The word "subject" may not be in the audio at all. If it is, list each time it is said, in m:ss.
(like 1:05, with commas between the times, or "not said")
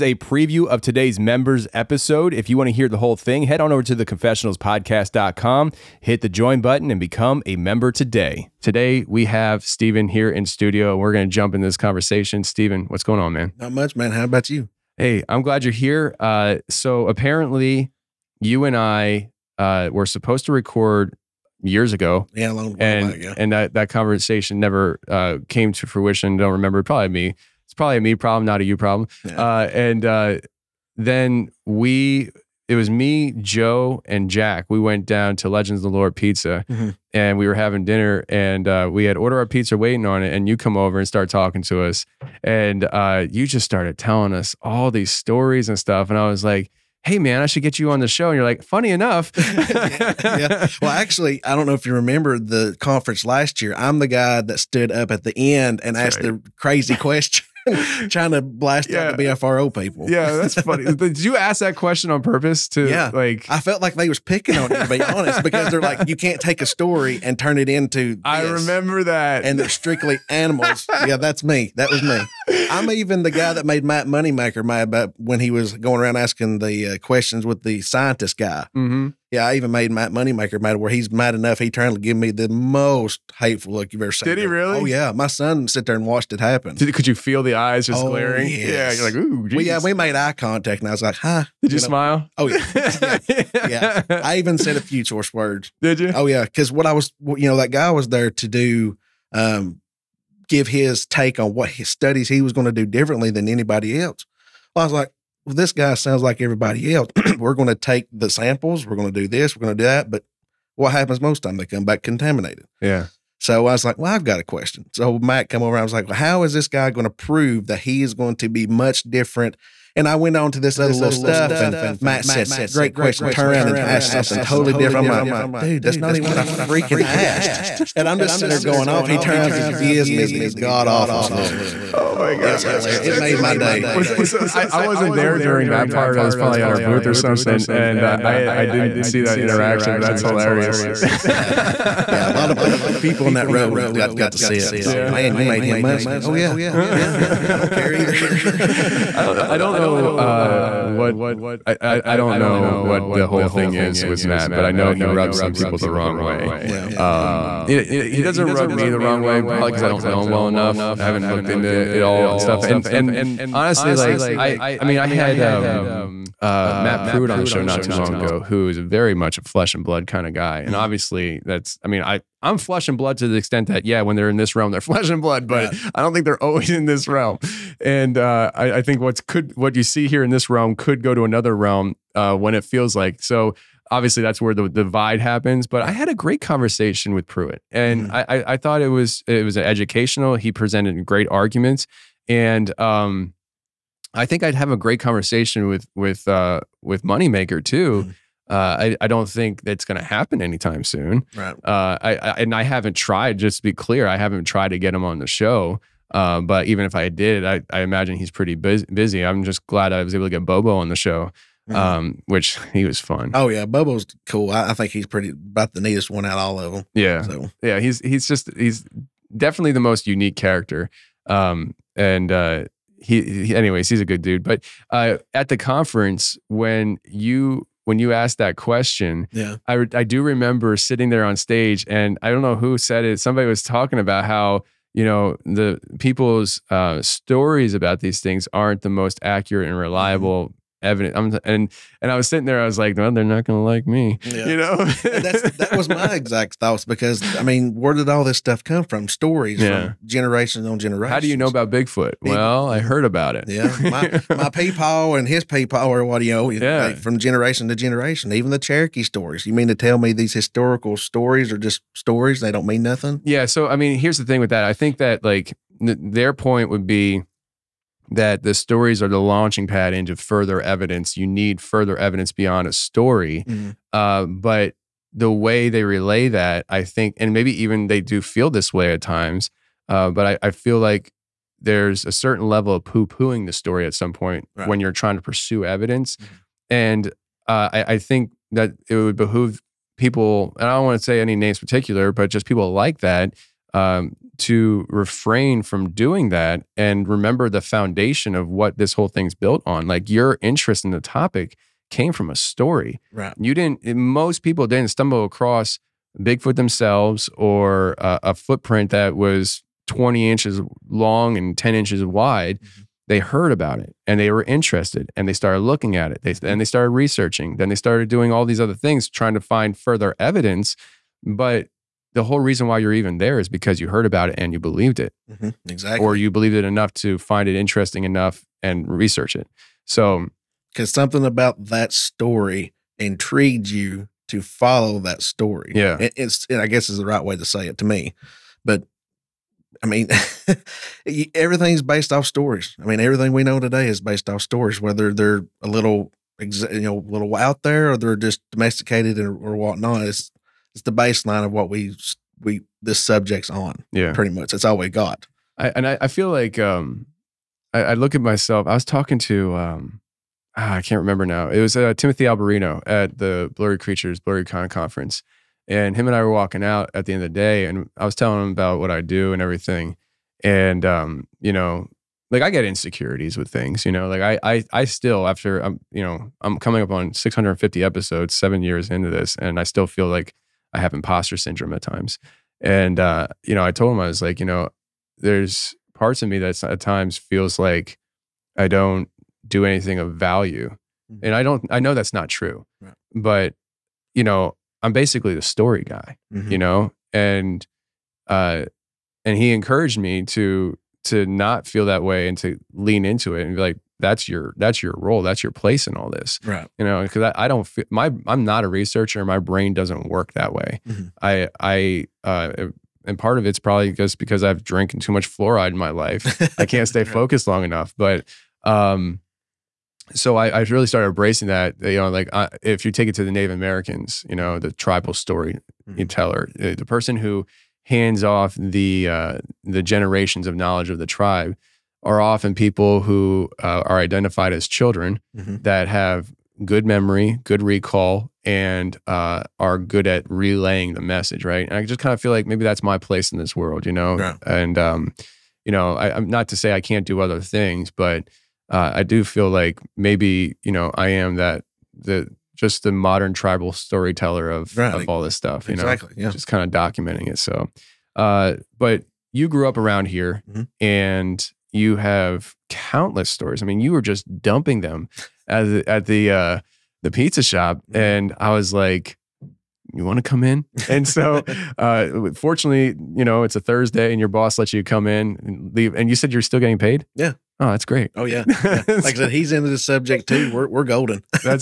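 5:53, 7:59.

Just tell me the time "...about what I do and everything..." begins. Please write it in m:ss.
6:08.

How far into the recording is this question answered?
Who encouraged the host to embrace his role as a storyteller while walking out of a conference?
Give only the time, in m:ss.
6:01.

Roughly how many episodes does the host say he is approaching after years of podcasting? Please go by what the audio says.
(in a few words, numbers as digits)
650.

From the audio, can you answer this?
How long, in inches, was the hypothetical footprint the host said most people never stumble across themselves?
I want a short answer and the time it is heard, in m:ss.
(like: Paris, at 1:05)
20 inches, at 5:09.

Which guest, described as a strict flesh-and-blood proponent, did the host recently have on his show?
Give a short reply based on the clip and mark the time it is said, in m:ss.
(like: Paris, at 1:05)
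Matt Pruitt, at 2:46.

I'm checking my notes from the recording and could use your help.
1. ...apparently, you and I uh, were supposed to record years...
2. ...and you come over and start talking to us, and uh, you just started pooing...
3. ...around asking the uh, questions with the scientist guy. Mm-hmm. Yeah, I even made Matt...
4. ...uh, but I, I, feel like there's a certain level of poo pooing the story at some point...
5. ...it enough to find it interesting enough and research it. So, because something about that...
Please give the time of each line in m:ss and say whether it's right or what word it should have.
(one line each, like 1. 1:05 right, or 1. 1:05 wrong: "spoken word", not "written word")
1. 0:17 right
2. 0:40 wrong: "telling", not "pooing"
3. 1:16 right
4. 4:39 right
5. 5:26 right.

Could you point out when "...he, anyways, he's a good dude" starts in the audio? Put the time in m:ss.
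3:43.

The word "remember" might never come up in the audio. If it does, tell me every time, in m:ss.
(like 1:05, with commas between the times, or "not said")
0:26, 0:51, 1:08, 3:50, 4:57, 6:00.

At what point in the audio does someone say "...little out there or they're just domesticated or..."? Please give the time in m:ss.
5:47.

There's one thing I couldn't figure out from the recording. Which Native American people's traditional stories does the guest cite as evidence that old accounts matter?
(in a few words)
Cherokee.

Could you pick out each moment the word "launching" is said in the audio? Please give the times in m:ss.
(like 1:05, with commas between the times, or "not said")
4:29.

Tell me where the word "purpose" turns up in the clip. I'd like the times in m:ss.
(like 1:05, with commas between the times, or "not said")
1:02.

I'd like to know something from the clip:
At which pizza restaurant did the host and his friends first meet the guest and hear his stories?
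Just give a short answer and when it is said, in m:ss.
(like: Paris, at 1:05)
Legends of the Lord Pizza, at 0:35.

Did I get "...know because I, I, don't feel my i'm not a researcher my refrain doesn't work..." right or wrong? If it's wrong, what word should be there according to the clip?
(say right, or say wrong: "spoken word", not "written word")
wrong: "brain", not "refrain".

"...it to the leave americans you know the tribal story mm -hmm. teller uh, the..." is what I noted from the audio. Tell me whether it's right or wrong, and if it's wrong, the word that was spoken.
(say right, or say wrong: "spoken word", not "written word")
wrong: "native", not "leave".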